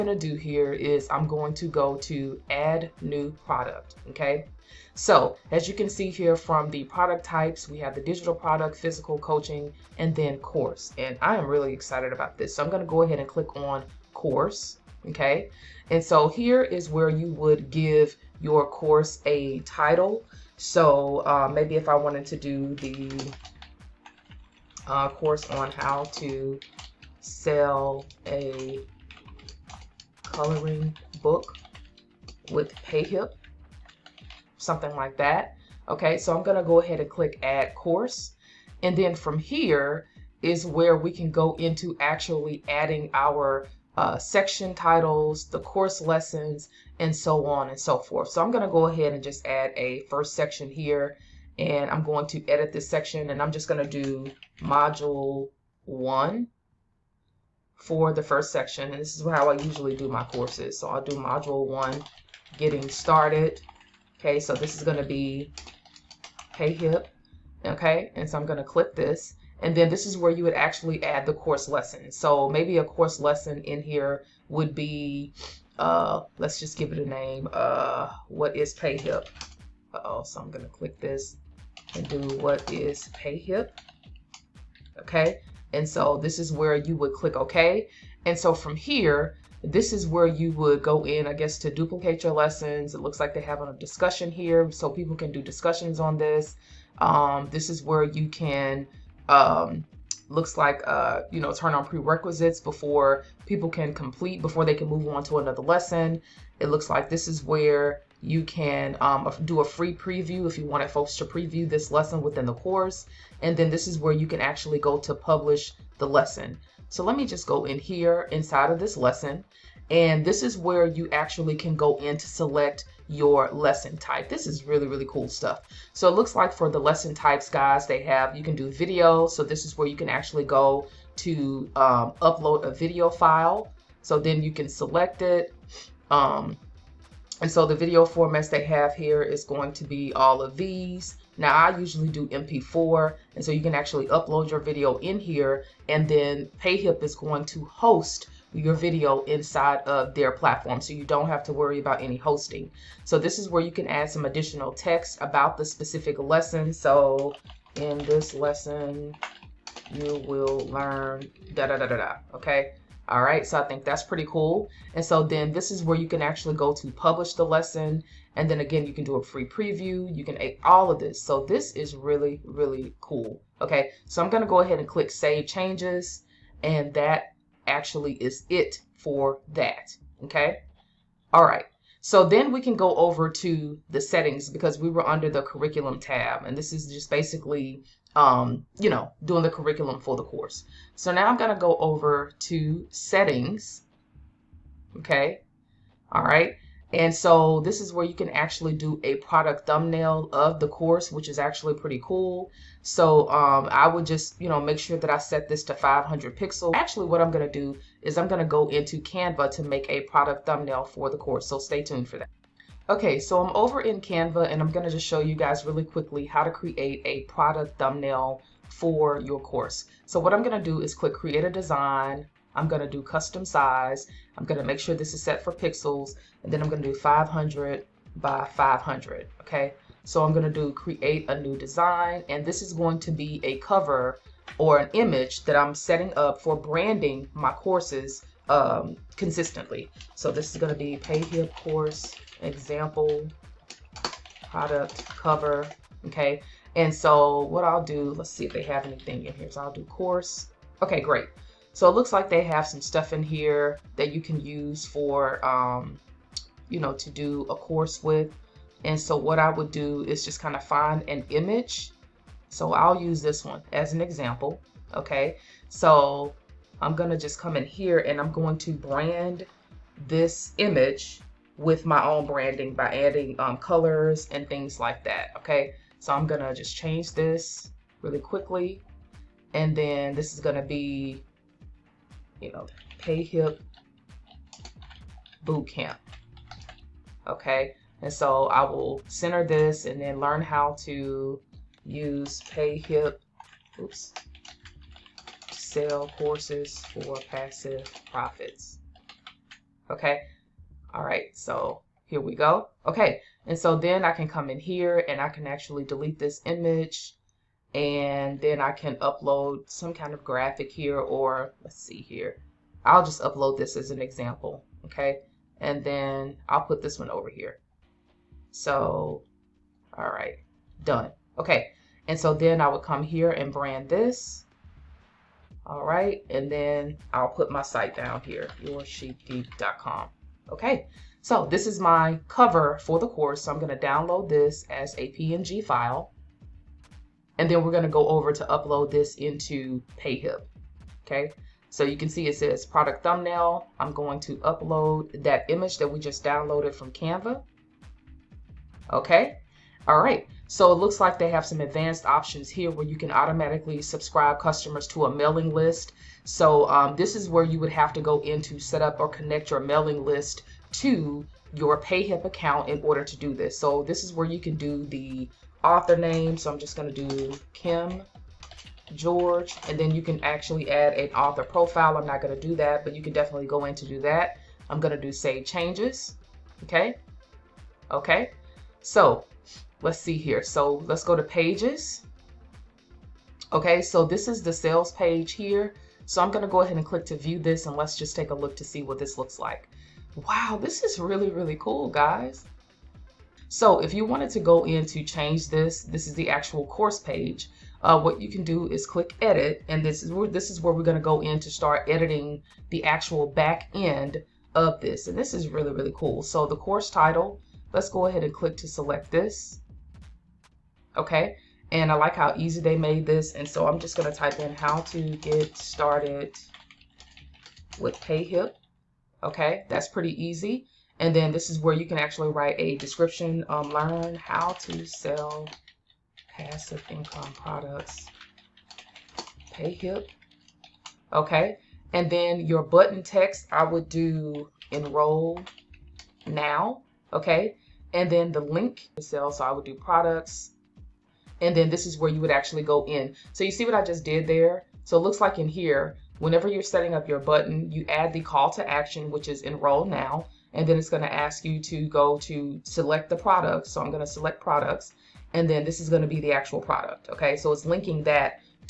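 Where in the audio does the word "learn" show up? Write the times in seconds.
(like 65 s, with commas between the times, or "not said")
160 s, 290 s, 423 s.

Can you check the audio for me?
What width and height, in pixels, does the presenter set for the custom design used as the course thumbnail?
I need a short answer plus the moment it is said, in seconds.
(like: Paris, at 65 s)
500 by 500, at 226 s.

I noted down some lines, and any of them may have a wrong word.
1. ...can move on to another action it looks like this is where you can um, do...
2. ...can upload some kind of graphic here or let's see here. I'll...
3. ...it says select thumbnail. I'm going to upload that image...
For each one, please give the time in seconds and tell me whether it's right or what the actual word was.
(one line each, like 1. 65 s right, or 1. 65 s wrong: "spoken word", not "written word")
1. 104 s wrong: "lesson", not "action"
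2. 308 s right
3. 342 s wrong: "product", not "select".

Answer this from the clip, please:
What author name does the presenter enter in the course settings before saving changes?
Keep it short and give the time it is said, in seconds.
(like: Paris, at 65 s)
Kim George, at 367 s.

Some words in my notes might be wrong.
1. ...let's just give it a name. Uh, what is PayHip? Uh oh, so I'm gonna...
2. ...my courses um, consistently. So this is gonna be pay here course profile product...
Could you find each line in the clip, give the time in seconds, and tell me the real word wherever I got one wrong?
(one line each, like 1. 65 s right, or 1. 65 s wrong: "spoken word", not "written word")
1. 76 s right
2. 237 s wrong: "example", not "profile".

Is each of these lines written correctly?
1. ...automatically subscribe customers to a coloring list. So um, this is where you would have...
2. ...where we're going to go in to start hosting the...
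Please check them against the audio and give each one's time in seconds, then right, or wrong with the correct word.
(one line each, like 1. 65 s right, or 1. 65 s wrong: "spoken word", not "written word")
1. 353 s wrong: "mailing", not "coloring"
2. 400 s wrong: "editing", not "hosting".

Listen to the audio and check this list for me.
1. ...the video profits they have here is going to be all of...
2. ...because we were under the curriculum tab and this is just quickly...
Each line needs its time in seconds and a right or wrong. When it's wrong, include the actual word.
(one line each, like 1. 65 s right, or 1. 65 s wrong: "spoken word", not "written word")
1. 137 s wrong: "formats", not "profits"
2. 184 s wrong: "basically", not "quickly".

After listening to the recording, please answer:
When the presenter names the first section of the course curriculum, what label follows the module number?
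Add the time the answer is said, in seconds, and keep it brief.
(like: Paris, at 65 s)
Getting started, at 62 s.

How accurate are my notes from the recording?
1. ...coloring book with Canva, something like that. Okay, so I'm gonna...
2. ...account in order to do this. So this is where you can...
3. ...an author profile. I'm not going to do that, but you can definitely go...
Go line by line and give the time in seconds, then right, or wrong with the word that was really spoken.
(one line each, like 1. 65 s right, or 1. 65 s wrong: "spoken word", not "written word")
1. 30 s wrong: "PayHip", not "Canva"
2. 362 s right
3. 370 s right.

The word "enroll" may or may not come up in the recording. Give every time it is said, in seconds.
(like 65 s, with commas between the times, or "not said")
434 s, 449 s.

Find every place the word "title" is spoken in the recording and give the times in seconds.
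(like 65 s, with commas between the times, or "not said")
19 s, 44 s, 406 s.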